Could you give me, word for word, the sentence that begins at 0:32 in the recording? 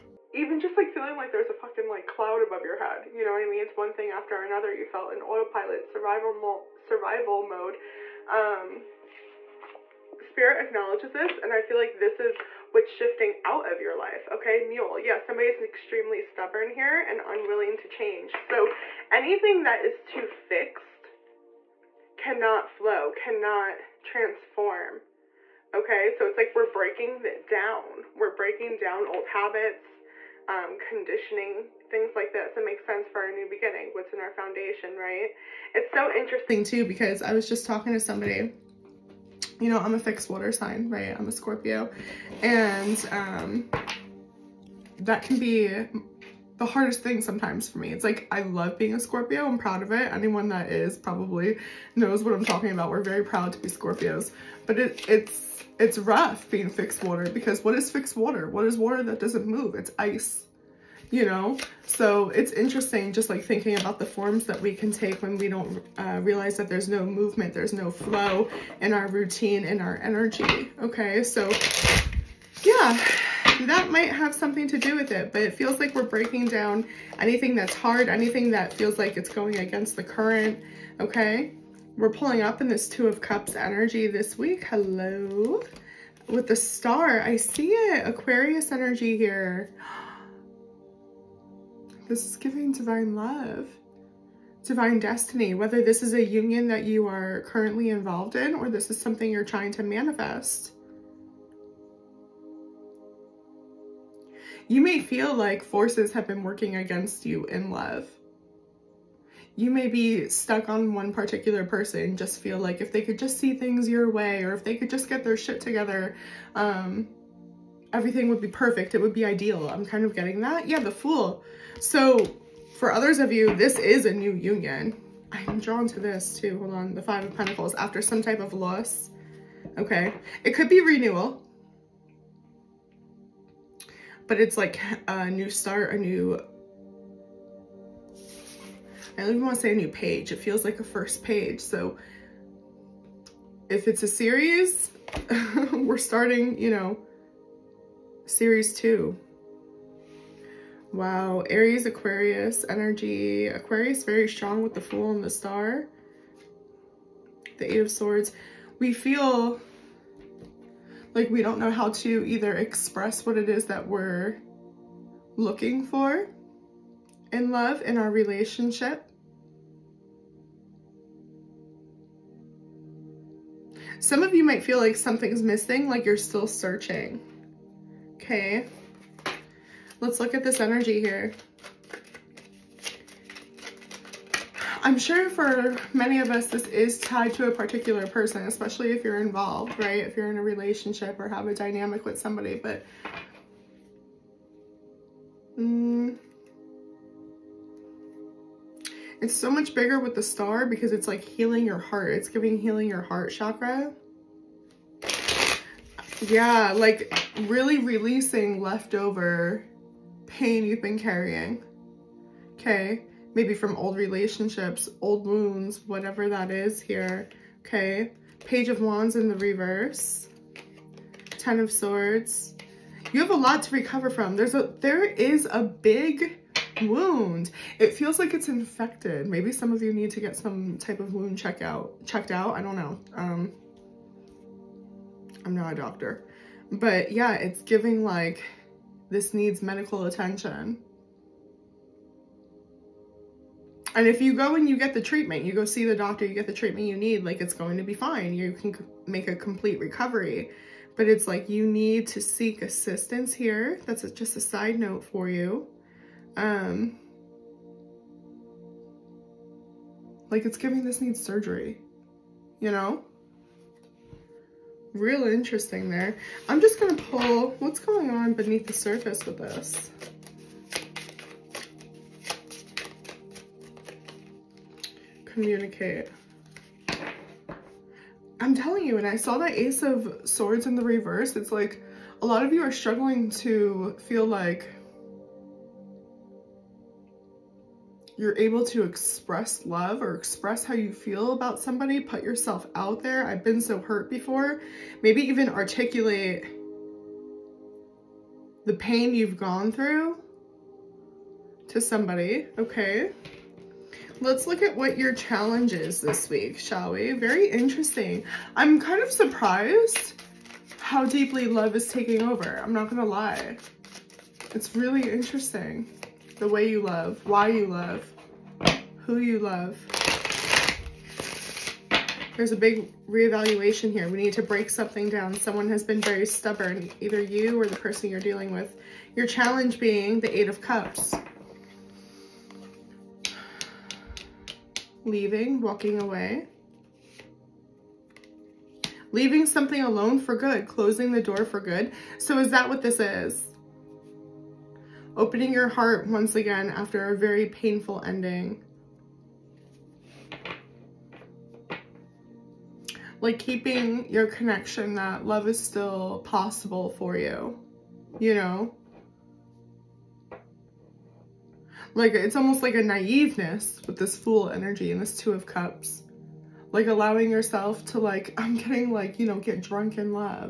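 It makes sense for our new beginning, what's in our foundation, right?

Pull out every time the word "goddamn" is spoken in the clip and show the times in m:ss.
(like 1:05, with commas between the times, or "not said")
not said.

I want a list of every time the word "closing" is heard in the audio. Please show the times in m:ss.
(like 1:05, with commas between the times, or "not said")
5:40.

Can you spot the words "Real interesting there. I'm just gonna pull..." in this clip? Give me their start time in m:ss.
4:24.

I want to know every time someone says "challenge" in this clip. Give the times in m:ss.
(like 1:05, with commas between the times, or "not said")
5:05, 5:29.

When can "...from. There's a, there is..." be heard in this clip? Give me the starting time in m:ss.
3:44.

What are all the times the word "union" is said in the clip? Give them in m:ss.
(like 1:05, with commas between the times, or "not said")
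1:36, 2:04.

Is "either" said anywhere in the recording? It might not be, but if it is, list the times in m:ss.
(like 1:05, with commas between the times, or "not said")
2:42, 5:27.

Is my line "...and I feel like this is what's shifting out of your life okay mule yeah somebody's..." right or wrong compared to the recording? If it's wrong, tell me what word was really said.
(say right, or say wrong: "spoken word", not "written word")
right.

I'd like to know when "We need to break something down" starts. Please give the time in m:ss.
5:24.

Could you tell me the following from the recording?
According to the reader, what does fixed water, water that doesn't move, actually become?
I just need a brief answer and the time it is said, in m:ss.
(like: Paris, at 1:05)
Ice, at 0:59.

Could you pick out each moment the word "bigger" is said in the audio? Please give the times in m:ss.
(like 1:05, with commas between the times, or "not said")
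3:19.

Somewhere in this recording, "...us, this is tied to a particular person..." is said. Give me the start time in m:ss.
3:06.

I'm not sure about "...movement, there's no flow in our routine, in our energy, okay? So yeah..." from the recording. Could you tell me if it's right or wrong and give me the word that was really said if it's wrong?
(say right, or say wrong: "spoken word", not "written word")
right.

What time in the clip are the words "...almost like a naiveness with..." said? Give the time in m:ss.
6:02.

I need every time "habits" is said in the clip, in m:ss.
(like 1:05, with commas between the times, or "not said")
0:29.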